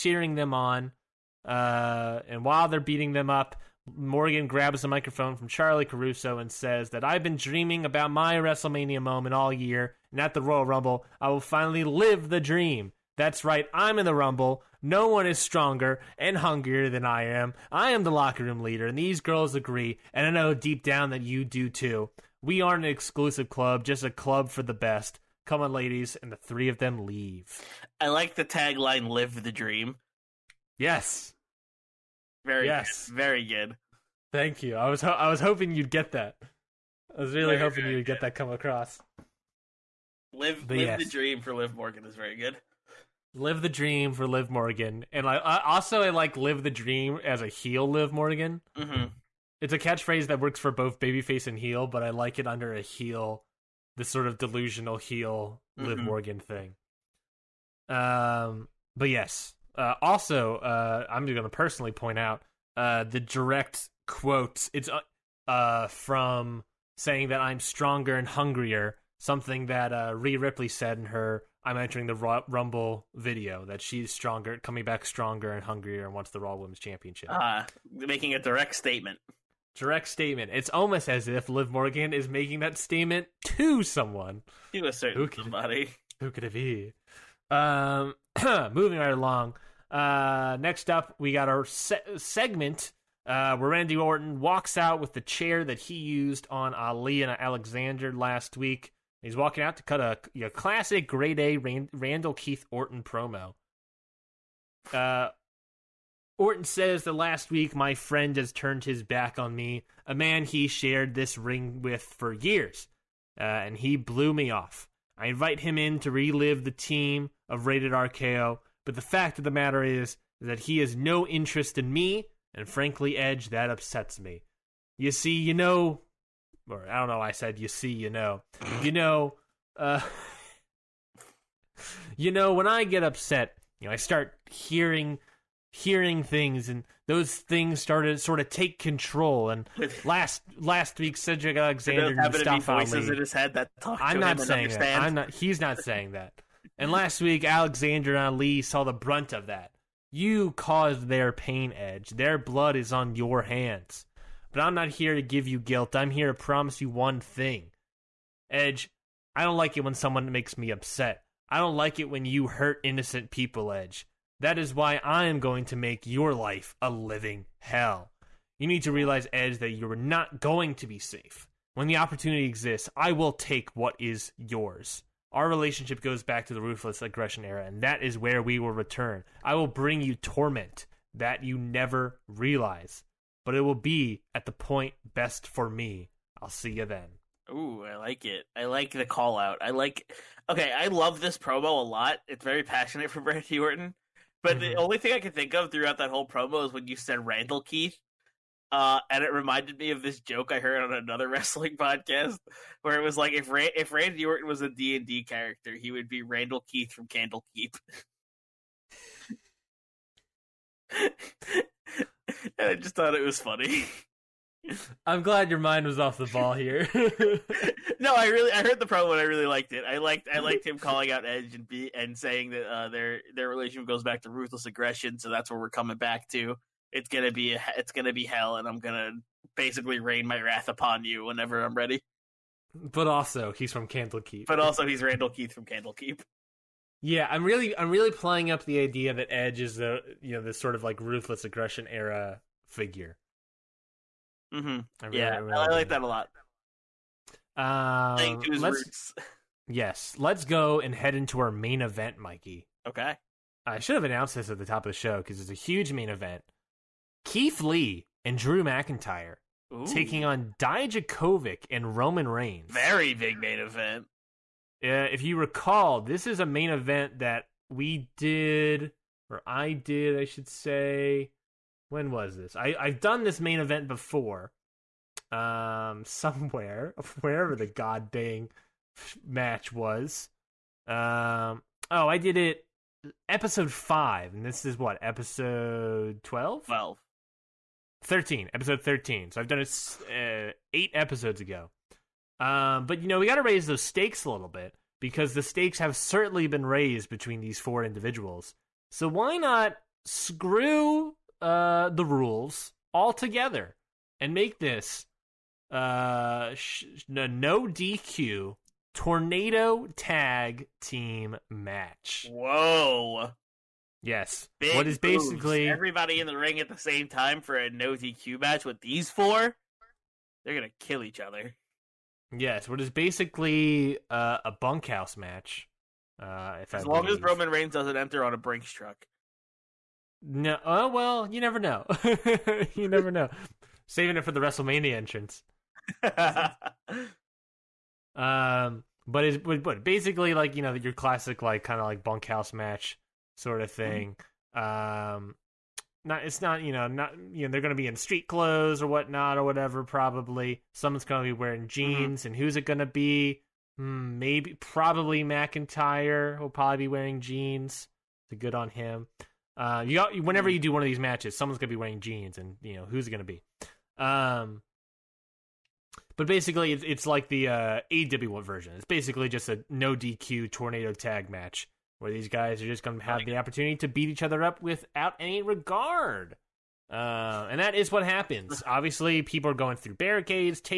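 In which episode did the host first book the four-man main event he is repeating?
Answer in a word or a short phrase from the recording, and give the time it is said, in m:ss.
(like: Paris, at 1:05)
5, at 4:43.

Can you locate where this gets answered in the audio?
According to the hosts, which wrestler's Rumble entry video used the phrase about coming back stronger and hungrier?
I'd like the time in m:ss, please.
1:10.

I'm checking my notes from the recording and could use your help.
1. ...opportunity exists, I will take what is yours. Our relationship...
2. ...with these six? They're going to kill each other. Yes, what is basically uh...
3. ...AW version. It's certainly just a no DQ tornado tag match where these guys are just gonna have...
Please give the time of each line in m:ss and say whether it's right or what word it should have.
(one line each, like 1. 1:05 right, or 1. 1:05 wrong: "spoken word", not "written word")
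1. 2:51 right
2. 5:18 wrong: "four", not "six"
3. 6:07 wrong: "basically", not "certainly".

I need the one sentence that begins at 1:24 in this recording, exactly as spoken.
To a certain who could, somebody.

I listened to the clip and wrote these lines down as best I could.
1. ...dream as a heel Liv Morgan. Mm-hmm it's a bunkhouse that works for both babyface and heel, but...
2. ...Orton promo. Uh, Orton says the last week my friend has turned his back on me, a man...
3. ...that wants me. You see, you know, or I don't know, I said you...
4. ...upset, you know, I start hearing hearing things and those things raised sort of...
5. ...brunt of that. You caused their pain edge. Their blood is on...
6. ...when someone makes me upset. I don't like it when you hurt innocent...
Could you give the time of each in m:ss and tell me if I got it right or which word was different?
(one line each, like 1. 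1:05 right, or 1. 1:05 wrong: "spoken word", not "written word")
1. 0:46 wrong: "catchphrase", not "bunkhouse"
2. 1:42 right
3. 2:03 wrong: "upsets", not "wants"
4. 2:13 wrong: "started", not "raised"
5. 2:28 right
6. 2:39 right.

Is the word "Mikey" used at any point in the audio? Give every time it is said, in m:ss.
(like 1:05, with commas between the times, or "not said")
4:12.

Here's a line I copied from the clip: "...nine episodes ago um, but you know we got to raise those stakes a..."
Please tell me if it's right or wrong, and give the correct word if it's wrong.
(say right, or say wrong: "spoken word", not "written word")
wrong: "eight", not "nine".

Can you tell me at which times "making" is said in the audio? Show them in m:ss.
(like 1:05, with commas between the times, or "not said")
1:18, 1:22.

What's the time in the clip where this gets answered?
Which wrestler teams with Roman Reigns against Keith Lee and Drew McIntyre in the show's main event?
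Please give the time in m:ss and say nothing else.
4:20.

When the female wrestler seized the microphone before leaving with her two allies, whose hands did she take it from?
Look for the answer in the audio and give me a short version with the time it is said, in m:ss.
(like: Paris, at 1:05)
Charly Caruso, at 0:05.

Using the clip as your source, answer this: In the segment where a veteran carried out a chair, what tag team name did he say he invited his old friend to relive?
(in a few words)
Rated RKO.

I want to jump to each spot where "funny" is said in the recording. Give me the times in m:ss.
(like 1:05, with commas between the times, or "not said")
3:33.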